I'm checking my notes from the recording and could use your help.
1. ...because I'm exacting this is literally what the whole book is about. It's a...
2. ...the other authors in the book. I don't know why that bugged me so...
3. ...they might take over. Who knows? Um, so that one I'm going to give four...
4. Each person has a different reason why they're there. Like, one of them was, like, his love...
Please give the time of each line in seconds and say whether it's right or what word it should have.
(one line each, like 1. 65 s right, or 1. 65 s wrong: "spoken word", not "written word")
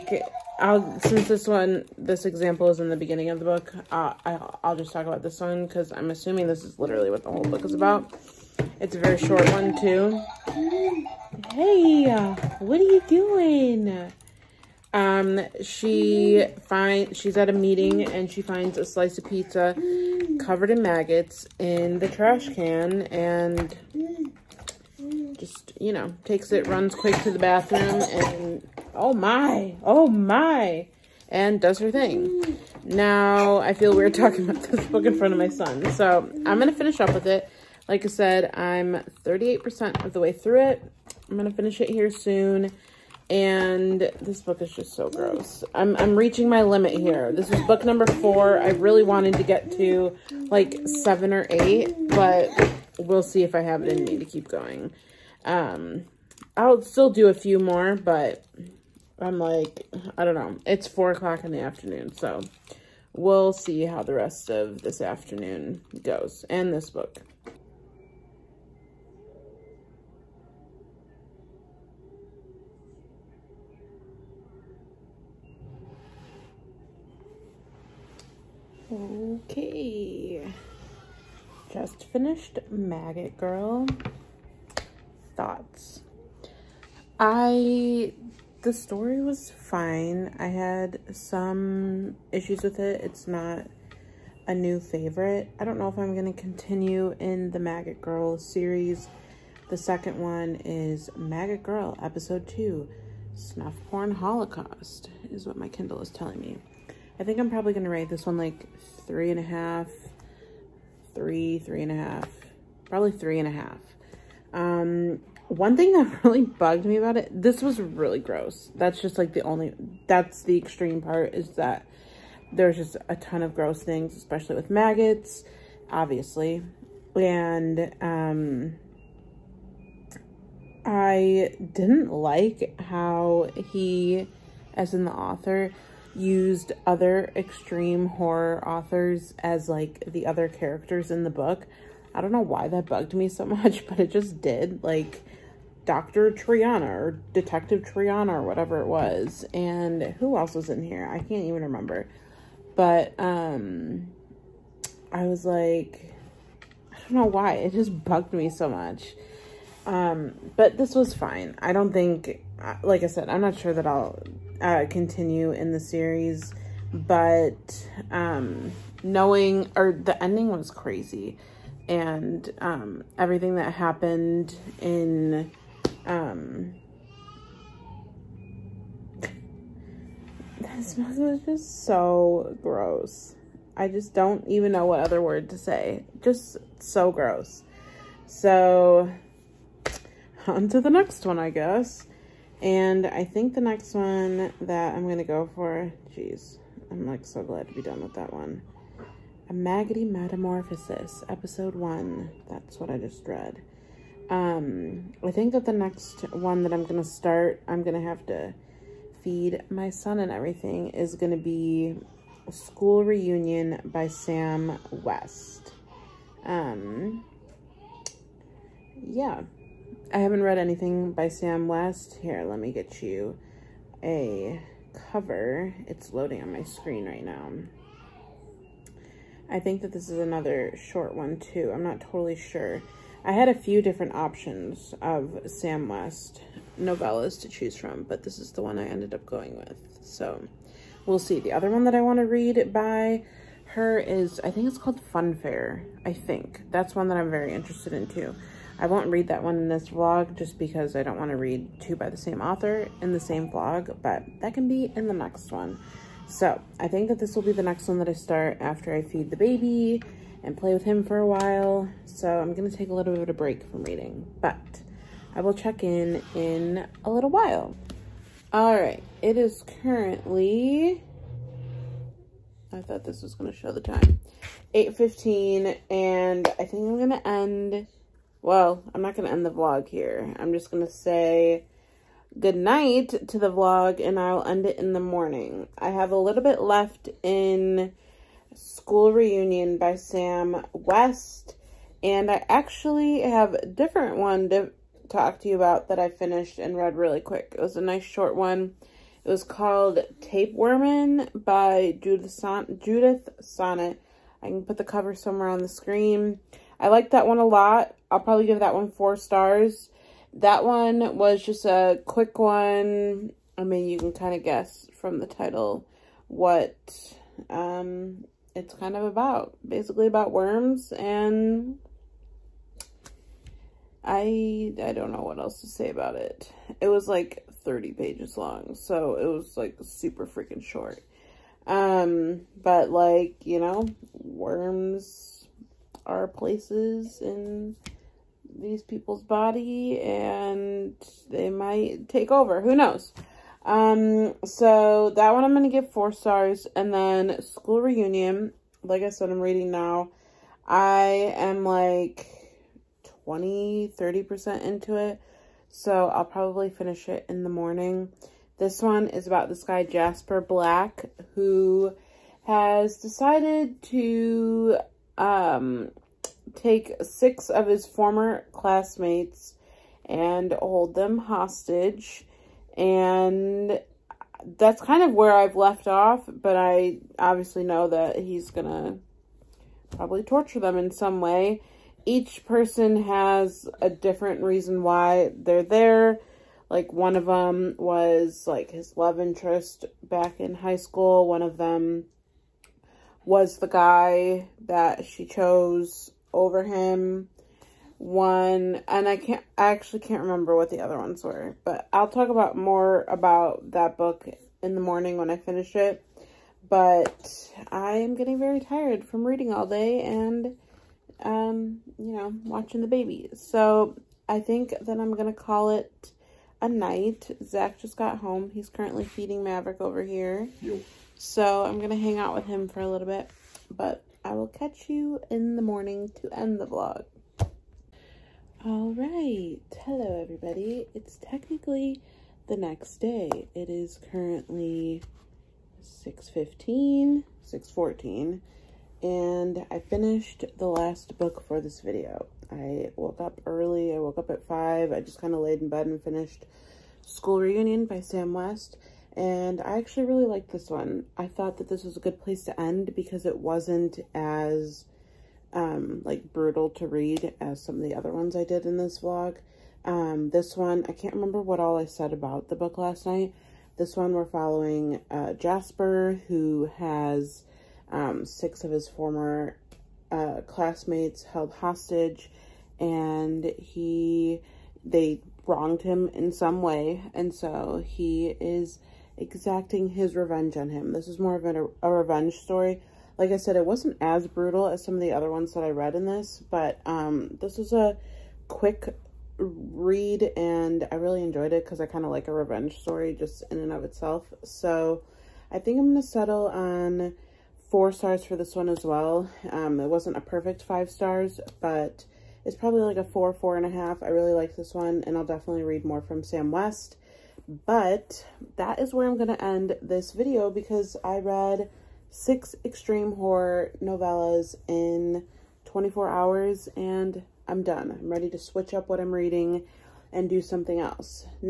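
1. 5 s wrong: "assuming", not "exacting"
2. 140 s wrong: "characters", not "authors"
3. 341 s right
4. 382 s right.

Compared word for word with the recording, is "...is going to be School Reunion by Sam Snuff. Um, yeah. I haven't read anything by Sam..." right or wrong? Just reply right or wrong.
wrong.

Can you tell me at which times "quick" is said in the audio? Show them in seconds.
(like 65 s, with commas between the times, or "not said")
26 s, 297 s, 312 s, 488 s.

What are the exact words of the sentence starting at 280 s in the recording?
I'm just going to say good night to the vlog and I'll end it in the morning.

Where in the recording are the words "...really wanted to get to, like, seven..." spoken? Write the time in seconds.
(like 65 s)
48 s.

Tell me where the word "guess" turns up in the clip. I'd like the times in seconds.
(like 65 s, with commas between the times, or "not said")
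191 s, 314 s.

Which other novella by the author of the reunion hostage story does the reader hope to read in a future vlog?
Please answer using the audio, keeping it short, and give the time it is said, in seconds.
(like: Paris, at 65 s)
Funfair, at 245 s.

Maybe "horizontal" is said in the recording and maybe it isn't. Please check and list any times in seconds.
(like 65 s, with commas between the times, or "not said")
not said.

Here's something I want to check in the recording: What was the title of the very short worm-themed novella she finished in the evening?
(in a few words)
Tapewyrmin.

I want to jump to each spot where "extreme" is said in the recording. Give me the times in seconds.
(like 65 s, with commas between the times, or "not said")
120 s, 137 s, 512 s.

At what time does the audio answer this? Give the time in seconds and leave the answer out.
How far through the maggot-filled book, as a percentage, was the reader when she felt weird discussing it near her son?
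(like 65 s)
39 s.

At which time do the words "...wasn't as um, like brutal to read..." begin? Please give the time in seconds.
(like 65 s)
453 s.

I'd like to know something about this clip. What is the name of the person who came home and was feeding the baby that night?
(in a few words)
Zack.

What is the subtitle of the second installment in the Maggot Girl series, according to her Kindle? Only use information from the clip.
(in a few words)
Snuff Porn Holocaust.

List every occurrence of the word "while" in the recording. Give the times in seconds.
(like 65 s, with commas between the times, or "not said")
261 s, 267 s.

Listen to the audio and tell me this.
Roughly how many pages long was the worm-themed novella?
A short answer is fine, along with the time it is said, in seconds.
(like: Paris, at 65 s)
30, at 327 s.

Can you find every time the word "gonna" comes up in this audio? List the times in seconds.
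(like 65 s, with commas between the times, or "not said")
378 s, 415 s, 421 s.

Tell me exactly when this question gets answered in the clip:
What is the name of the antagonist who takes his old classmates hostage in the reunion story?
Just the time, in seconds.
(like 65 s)
359 s.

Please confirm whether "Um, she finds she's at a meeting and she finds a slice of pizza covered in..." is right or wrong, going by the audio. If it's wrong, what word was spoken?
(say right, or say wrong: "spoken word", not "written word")
right.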